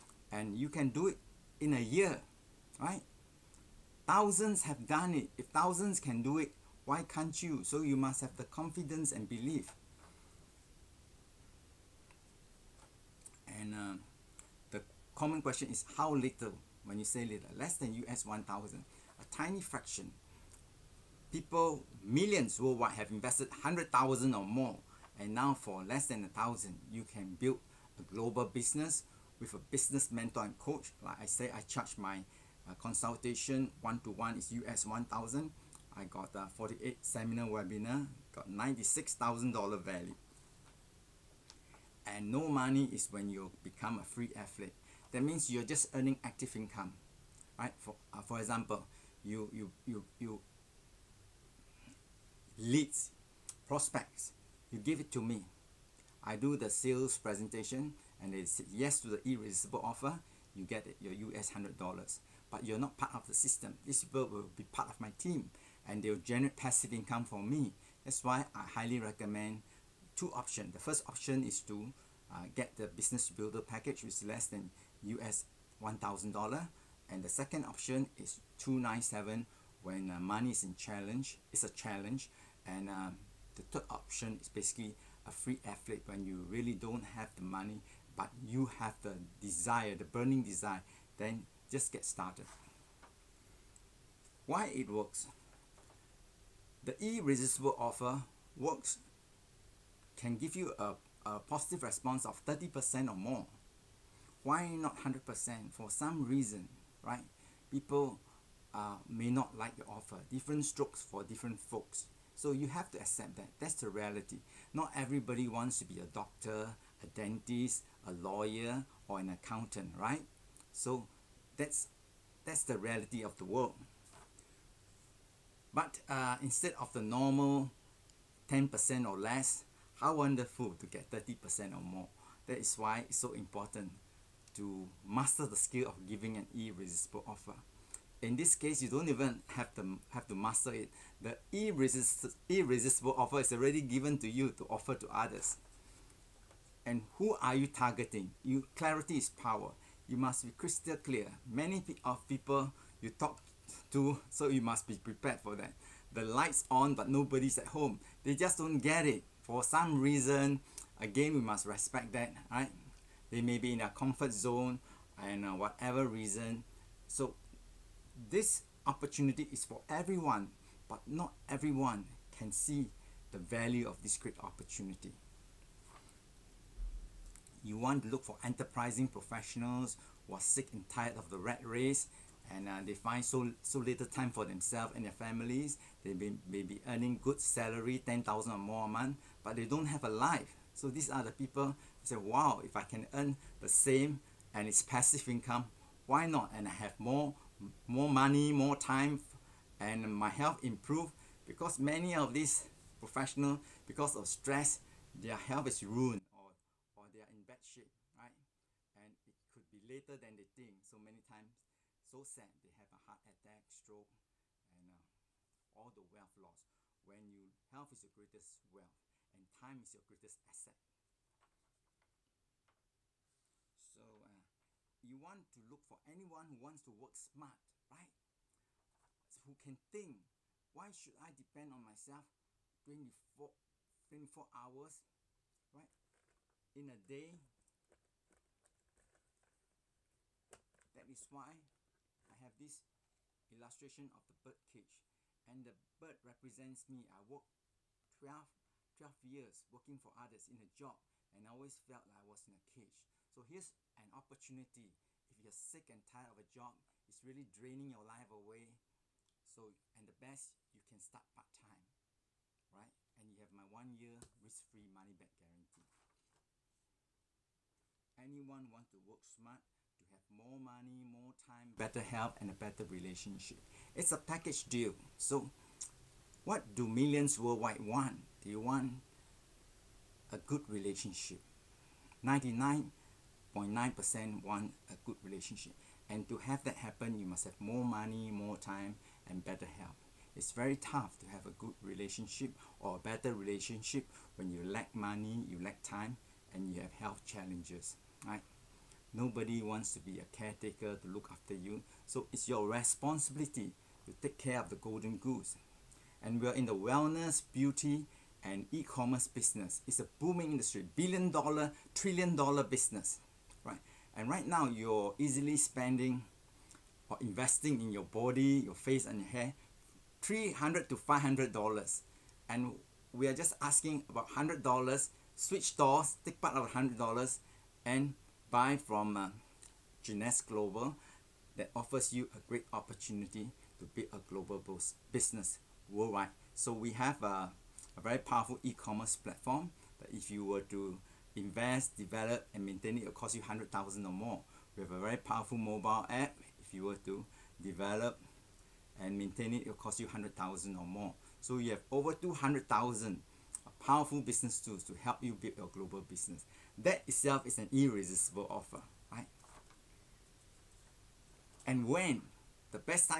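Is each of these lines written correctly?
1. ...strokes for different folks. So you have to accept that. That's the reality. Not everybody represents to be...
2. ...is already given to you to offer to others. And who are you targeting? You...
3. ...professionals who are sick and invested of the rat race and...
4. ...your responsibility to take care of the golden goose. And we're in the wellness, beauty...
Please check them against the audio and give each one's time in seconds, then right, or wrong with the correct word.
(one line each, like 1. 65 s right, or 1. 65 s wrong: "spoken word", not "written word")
1. 110 s wrong: "wants", not "represents"
2. 143 s right
3. 179 s wrong: "tired", not "invested"
4. 302 s right.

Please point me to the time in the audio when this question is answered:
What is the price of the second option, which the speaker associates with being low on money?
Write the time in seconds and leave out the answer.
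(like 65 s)
78 s.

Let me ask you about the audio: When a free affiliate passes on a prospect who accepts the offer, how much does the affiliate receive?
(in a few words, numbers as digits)
US $100.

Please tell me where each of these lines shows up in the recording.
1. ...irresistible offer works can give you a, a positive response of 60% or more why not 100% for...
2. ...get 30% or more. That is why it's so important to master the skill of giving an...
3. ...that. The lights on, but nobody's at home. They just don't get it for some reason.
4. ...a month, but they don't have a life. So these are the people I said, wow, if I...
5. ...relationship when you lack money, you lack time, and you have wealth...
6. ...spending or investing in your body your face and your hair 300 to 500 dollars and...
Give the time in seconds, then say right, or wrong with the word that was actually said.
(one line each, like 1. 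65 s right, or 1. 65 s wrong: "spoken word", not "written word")
1. 96 s wrong: "30", not "60"
2. 130 s right
3. 155 s right
4. 188 s right
5. 293 s wrong: "health", not "wealth"
6. 315 s right.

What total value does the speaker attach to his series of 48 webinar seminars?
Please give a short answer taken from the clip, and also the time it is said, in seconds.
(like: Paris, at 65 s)
$96,000, at 38 s.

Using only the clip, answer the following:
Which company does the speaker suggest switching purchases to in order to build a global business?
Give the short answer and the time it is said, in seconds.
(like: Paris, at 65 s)
Jeunesse Global, at 330 s.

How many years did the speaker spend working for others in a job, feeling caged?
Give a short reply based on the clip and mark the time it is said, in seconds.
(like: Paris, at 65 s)
12, at 248 s.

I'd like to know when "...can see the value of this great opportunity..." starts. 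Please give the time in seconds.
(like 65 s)
172 s.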